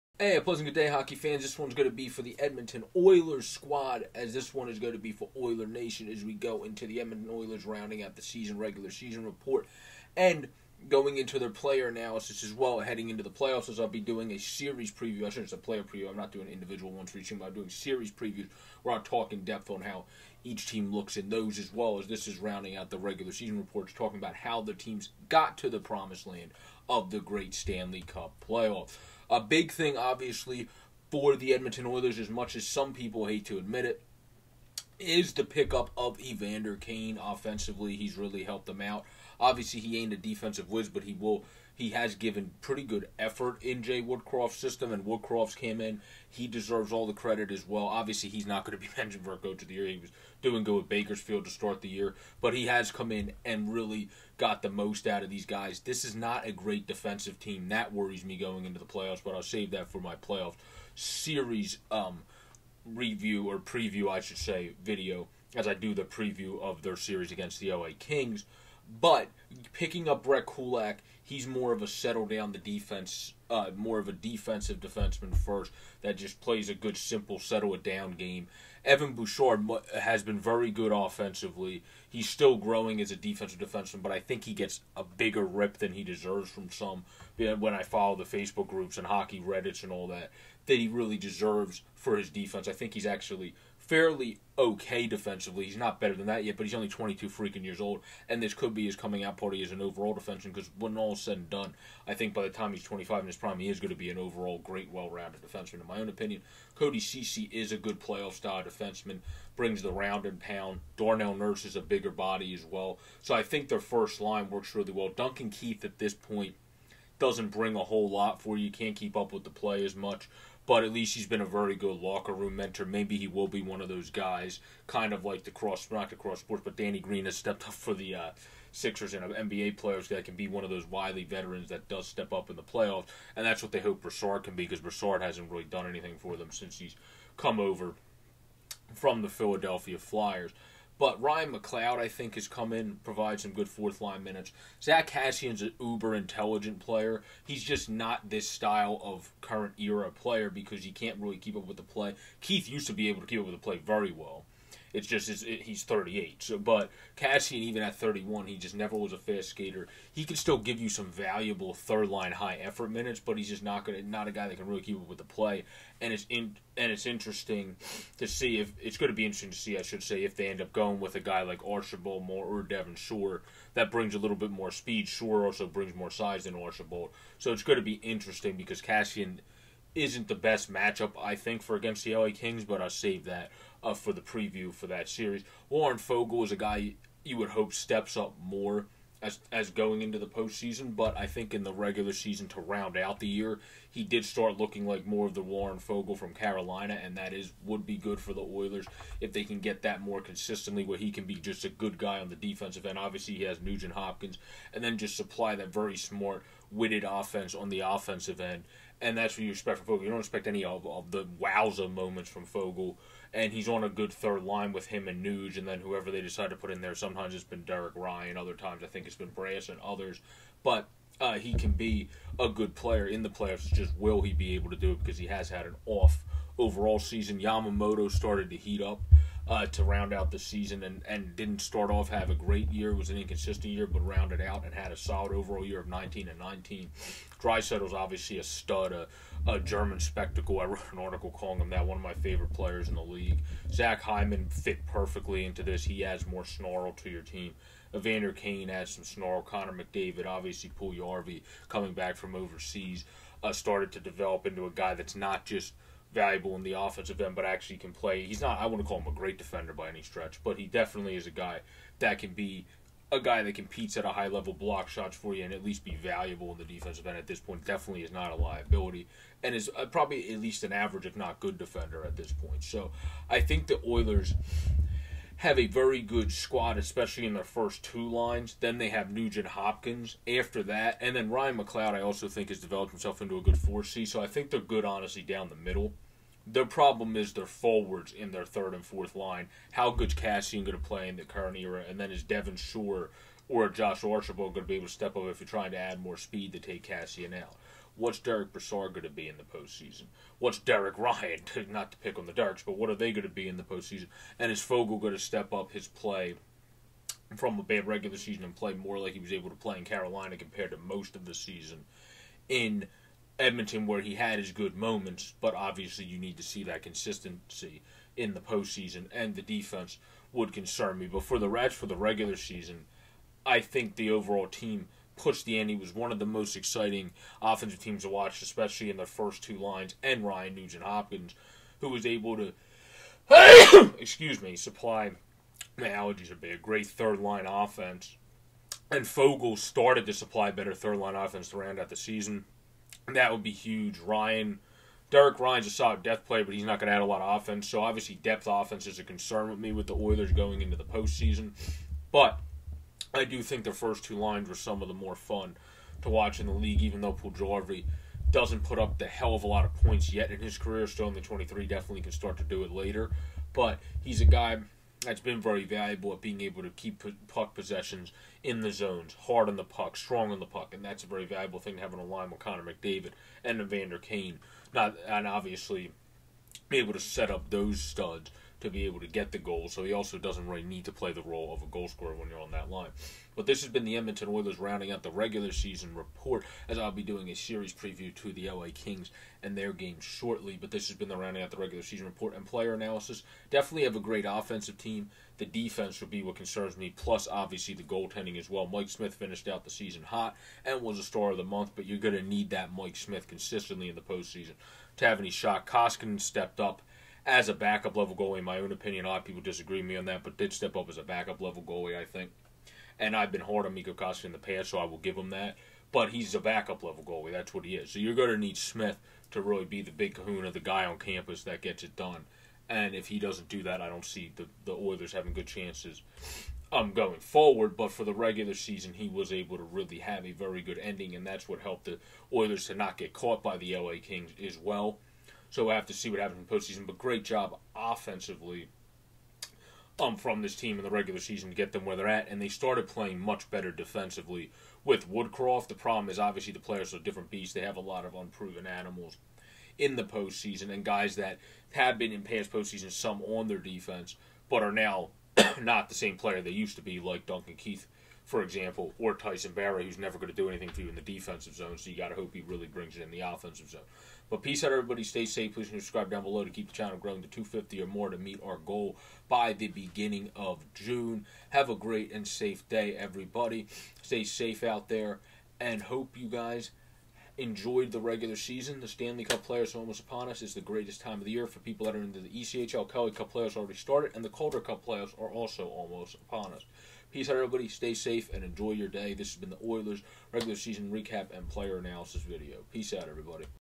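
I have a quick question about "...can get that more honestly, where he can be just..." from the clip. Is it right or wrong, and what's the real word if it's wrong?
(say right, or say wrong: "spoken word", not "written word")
wrong: "consistently", not "honestly".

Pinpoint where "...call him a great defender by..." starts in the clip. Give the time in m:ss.
4:18.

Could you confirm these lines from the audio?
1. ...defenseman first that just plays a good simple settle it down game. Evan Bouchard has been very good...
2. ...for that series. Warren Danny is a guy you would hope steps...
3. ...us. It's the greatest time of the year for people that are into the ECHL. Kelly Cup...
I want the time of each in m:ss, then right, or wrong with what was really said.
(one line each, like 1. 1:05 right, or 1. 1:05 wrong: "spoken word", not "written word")
1. 1:14 right
2. 3:04 wrong: "Foegele", not "Danny"
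3. 8:00 right.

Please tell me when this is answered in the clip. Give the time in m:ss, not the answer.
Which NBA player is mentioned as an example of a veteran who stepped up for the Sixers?
2:06.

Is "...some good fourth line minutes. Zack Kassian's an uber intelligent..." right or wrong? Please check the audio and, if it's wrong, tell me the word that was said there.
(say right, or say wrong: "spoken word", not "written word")
right.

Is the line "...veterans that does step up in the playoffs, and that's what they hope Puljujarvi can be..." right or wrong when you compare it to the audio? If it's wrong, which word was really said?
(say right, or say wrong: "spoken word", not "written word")
wrong: "Brassard", not "Puljujarvi".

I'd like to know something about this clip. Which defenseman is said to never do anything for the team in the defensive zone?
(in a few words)
Tyson Barrie.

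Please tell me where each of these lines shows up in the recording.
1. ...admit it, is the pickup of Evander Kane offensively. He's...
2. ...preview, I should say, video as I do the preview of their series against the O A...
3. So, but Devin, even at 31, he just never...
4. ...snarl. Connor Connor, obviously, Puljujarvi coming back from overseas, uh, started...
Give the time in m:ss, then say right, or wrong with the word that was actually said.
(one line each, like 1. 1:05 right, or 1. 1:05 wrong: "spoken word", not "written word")
1. 0:33 right
2. 1:03 right
3. 2:36 wrong: "Kassian", not "Devin"
4. 4:09 wrong: "McDavid", not "Connor".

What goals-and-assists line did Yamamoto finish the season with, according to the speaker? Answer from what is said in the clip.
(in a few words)
19 and 19.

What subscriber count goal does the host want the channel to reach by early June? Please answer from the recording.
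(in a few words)
250.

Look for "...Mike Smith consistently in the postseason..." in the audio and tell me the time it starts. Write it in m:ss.
6:42.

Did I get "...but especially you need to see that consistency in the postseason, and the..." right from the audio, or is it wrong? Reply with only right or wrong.
wrong.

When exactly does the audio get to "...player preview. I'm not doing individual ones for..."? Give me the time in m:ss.
0:15.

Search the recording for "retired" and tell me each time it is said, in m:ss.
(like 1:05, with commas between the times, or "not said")
not said.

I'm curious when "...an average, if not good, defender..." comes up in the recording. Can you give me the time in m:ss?
4:30.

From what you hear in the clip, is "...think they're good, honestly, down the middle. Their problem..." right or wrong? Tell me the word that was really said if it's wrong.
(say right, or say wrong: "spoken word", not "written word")
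right.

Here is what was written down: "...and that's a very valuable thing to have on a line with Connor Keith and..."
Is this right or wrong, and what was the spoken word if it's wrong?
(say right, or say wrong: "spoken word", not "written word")
wrong: "McDavid", not "Keith".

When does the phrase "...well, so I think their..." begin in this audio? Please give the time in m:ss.
1:52.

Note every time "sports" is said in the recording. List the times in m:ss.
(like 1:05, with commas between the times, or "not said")
2:06.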